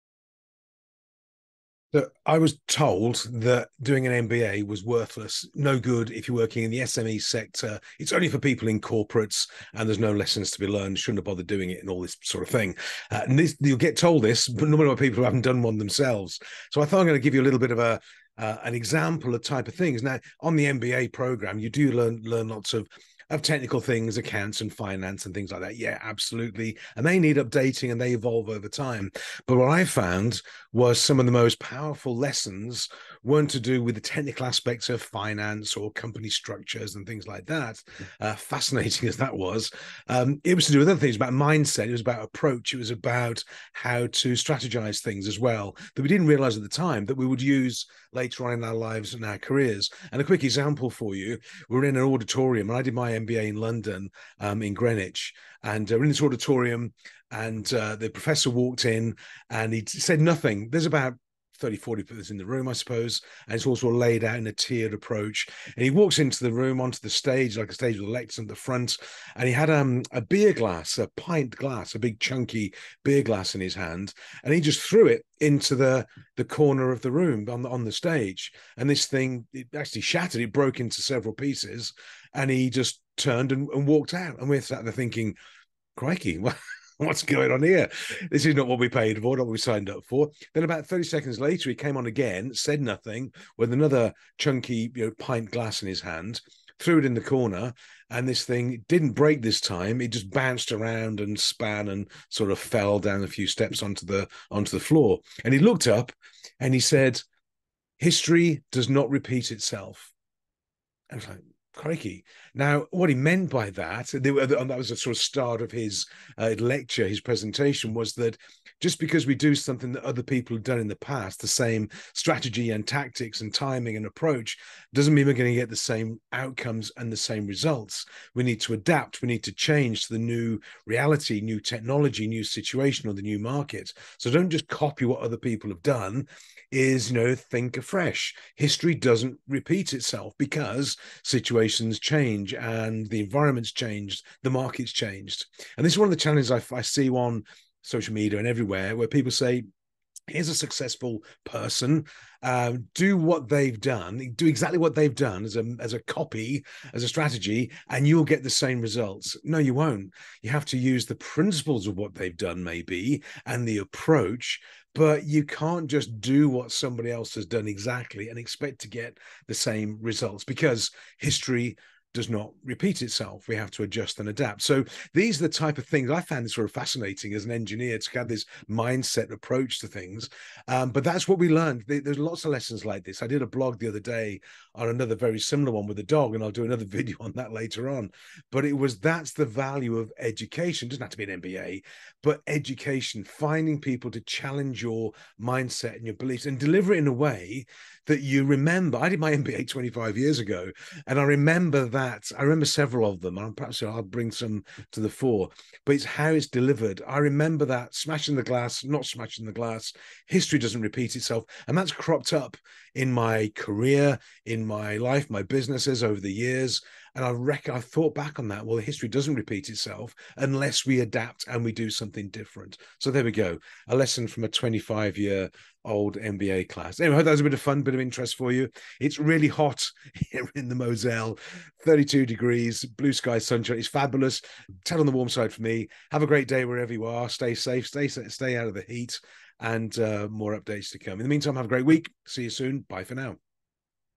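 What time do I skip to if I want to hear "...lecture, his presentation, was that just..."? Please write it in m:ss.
1:56.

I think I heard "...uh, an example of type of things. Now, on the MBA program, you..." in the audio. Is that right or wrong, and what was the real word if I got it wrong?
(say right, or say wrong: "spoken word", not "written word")
right.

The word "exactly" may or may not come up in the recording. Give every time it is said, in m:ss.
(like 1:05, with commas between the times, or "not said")
2:34, 2:47.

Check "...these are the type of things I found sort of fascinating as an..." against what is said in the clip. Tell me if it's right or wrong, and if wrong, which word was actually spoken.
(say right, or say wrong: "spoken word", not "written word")
right.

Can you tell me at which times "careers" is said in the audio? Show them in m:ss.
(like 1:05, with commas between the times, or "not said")
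0:49, 3:33.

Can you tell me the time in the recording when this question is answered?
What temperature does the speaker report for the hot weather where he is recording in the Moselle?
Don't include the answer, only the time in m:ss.
3:51.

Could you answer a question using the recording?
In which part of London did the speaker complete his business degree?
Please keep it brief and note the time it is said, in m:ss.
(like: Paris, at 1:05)
Greenwich, at 0:54.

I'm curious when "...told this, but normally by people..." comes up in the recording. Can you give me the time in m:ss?
0:13.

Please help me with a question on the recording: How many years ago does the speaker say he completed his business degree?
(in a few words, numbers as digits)
25.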